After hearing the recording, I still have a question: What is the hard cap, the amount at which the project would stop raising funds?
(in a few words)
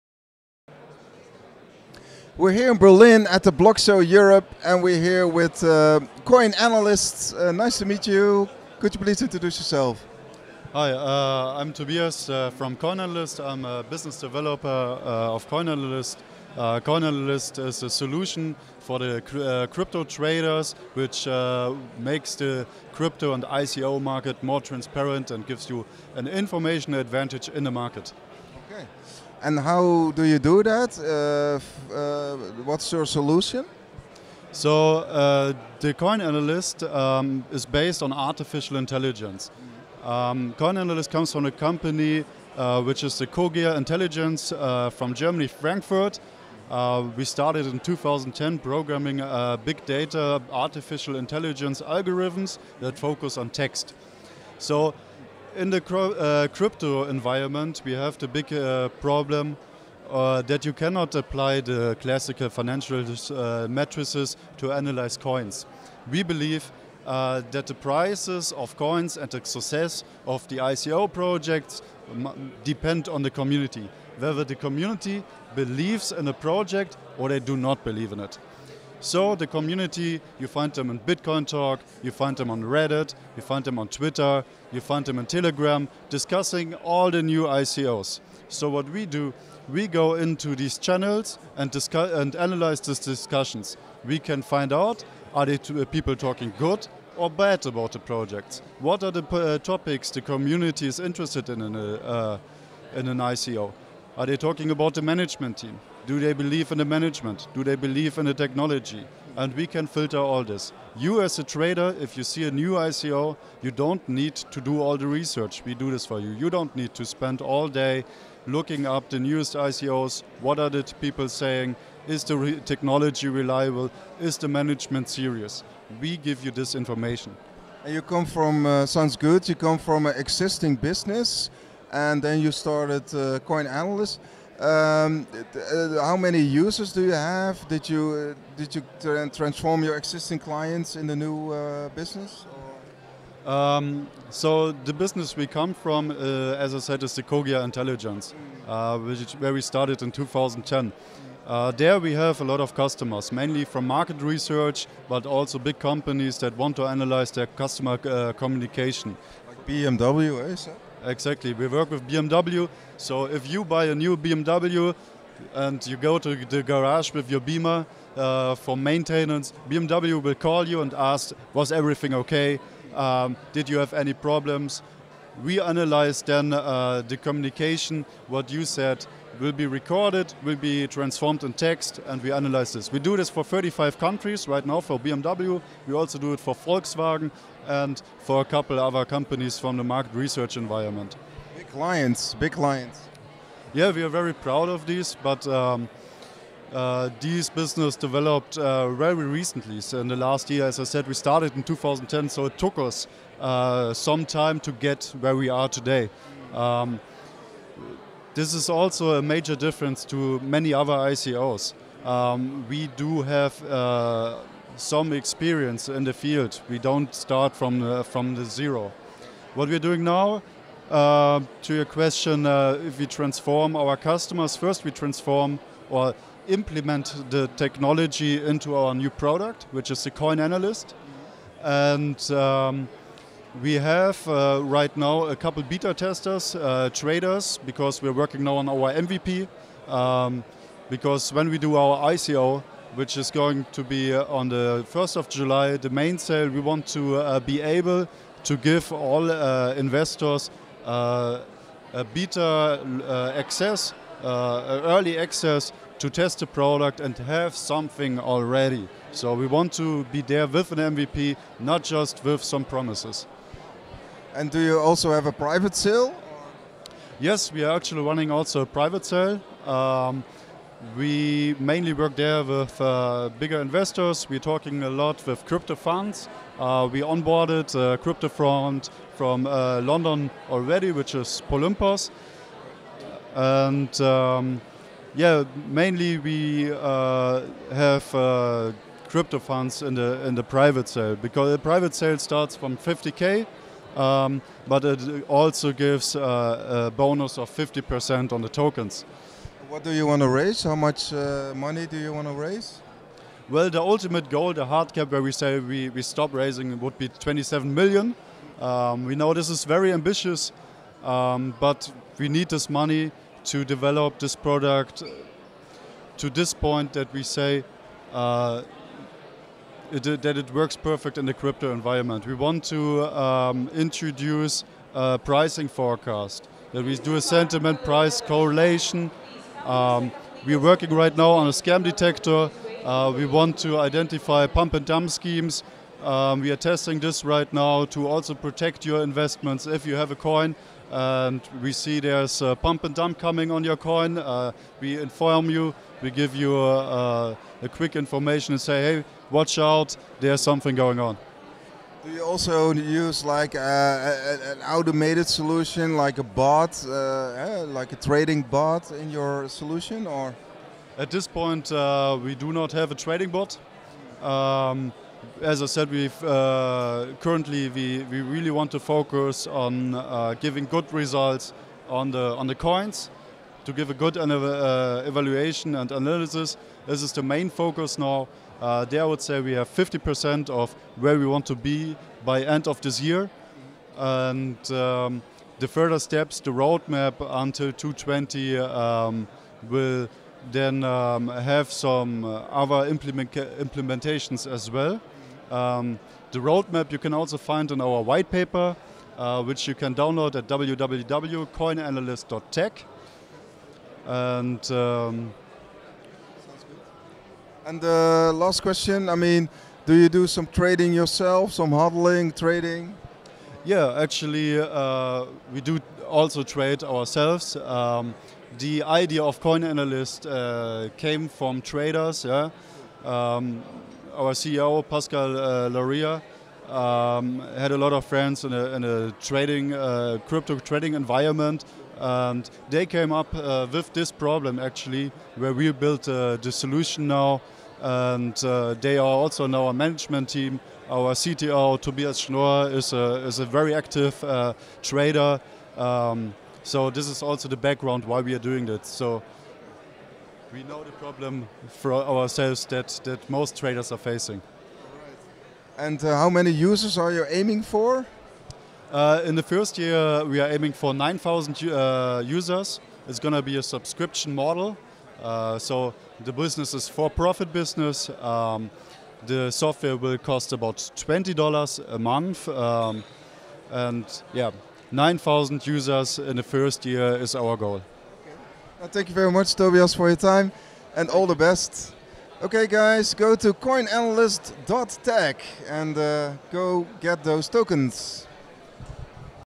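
27 million.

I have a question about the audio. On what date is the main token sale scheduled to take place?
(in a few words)
1st of July.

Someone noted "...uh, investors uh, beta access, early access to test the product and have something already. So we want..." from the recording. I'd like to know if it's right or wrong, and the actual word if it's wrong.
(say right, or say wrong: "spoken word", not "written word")
right.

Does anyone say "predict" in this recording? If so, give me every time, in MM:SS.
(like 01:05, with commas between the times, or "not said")
not said.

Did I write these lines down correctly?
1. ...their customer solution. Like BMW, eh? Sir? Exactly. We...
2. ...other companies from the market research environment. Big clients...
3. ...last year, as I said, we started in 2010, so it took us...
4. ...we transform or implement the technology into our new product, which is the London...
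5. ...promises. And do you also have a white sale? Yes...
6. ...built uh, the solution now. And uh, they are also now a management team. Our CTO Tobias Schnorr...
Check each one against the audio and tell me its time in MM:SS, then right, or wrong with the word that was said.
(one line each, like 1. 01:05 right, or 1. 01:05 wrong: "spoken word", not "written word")
1. 02:37 wrong: "communication", not "solution"
2. 03:08 right
3. 03:20 right
4. 03:44 wrong: "Coin", not "London"
5. 04:22 wrong: "private", not "white"
6. 07:15 right.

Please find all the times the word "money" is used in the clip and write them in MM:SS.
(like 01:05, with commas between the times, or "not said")
05:01, 05:12.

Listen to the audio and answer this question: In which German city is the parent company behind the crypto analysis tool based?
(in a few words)
Frankfurt.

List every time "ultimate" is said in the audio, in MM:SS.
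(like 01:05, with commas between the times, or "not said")
05:03.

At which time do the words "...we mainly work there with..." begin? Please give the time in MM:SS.
04:30.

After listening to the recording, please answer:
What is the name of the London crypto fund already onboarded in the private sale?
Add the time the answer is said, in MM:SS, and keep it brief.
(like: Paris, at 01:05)
Polympos, at 04:41.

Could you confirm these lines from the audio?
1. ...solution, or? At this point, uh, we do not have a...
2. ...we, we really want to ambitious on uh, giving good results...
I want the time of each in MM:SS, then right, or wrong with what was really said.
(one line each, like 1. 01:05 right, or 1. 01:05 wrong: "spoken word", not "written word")
1. 05:59 right
2. 06:07 wrong: "focus", not "ambitious".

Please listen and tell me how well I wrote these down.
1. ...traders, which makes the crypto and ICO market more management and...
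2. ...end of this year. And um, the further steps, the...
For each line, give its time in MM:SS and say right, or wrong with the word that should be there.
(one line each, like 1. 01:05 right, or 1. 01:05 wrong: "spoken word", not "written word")
1. 00:20 wrong: "transparent", not "management"
2. 06:22 right.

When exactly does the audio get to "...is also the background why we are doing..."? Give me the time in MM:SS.
07:27.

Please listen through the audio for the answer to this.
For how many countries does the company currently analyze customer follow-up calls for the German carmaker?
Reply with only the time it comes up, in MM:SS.
03:03.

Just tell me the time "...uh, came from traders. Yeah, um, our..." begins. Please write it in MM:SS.
07:00.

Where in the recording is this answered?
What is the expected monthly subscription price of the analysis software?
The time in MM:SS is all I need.
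07:50.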